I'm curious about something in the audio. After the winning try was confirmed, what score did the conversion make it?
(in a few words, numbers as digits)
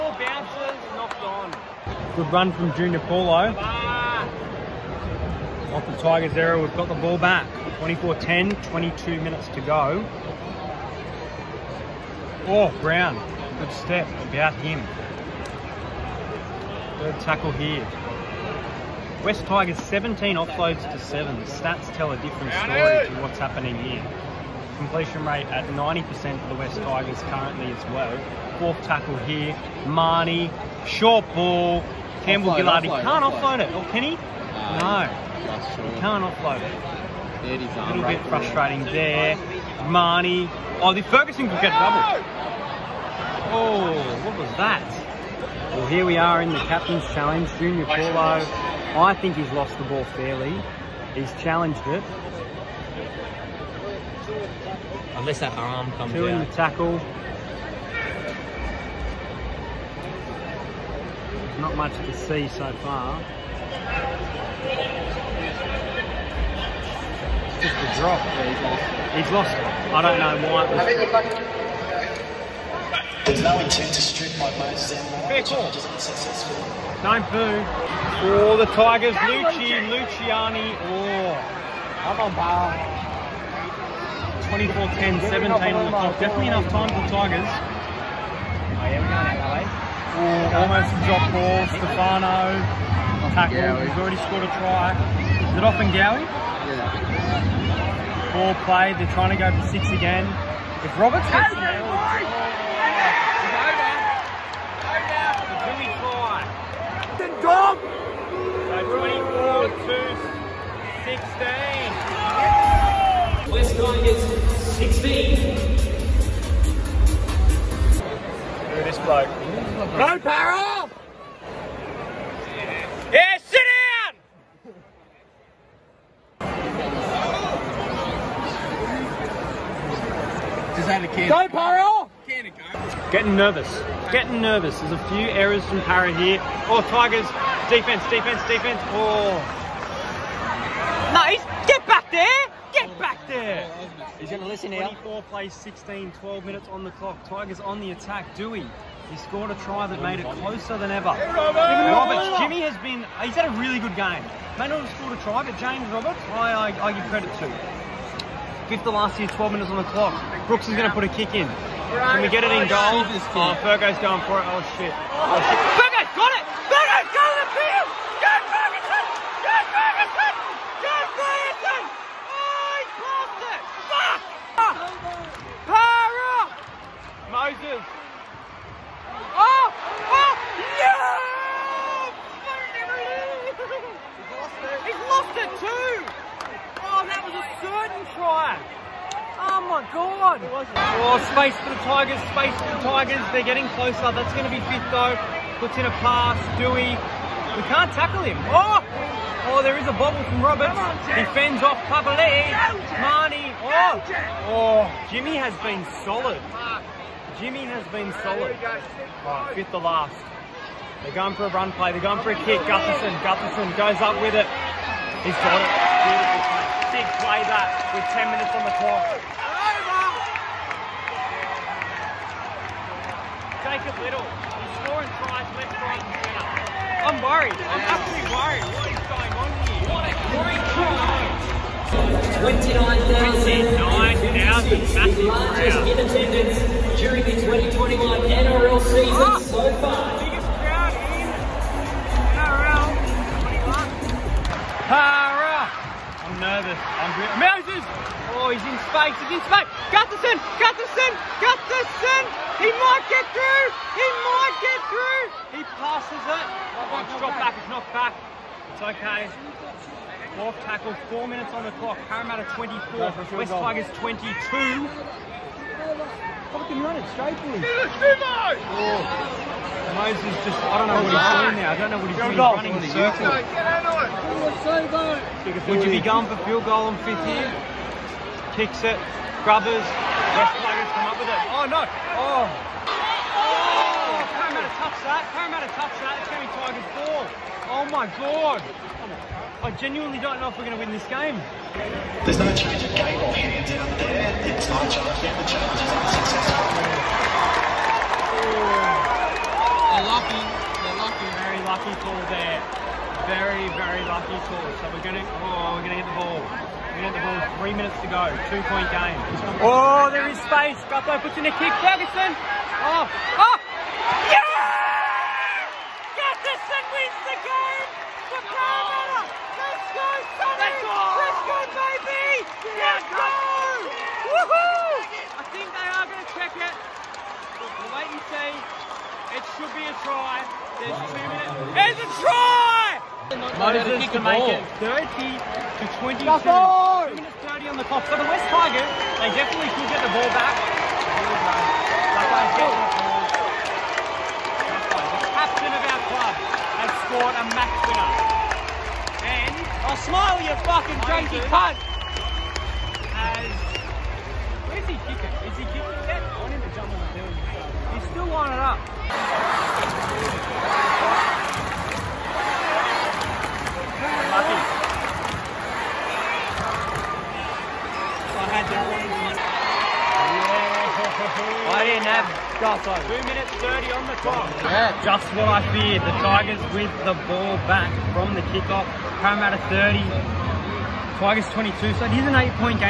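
30 to 22.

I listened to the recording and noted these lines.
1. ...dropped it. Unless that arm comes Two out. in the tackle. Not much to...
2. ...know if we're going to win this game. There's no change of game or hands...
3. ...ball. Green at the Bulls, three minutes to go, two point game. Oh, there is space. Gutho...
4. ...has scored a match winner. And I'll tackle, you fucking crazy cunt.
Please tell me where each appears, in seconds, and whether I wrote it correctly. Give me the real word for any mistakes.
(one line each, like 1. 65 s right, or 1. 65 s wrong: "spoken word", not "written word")
1. 51 s wrong: "challenged", not "dropped"
2. 290 s right
3. 306 s right
4. 346 s wrong: "smile", not "tackle".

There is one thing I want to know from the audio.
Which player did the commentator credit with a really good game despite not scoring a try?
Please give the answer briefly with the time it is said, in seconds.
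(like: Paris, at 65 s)
James Roberts, at 155 s.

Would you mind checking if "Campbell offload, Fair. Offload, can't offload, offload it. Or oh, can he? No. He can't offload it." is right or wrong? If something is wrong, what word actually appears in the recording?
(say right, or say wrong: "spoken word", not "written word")
wrong: "Gillard", not "Fair".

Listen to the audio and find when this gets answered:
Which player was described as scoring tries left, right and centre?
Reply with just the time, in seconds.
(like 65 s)
223 s.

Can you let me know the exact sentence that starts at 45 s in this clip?
Well, here we are in the captain's challenge.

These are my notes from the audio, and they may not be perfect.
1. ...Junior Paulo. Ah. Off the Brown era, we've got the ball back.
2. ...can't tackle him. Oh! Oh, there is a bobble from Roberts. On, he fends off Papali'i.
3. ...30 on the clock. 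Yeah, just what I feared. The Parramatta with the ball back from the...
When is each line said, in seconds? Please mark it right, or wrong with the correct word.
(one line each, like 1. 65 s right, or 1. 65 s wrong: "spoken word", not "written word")
1. 2 s wrong: "Tigers", not "Brown"
2. 197 s right
3. 373 s wrong: "Tigers", not "Parramatta".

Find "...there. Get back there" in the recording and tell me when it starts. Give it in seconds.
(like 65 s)
142 s.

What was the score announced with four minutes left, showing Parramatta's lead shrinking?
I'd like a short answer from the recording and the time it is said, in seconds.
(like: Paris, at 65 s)
Parramatta 24, West Tigers 22, at 262 s.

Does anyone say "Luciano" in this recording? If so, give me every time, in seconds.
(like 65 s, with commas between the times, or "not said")
79 s.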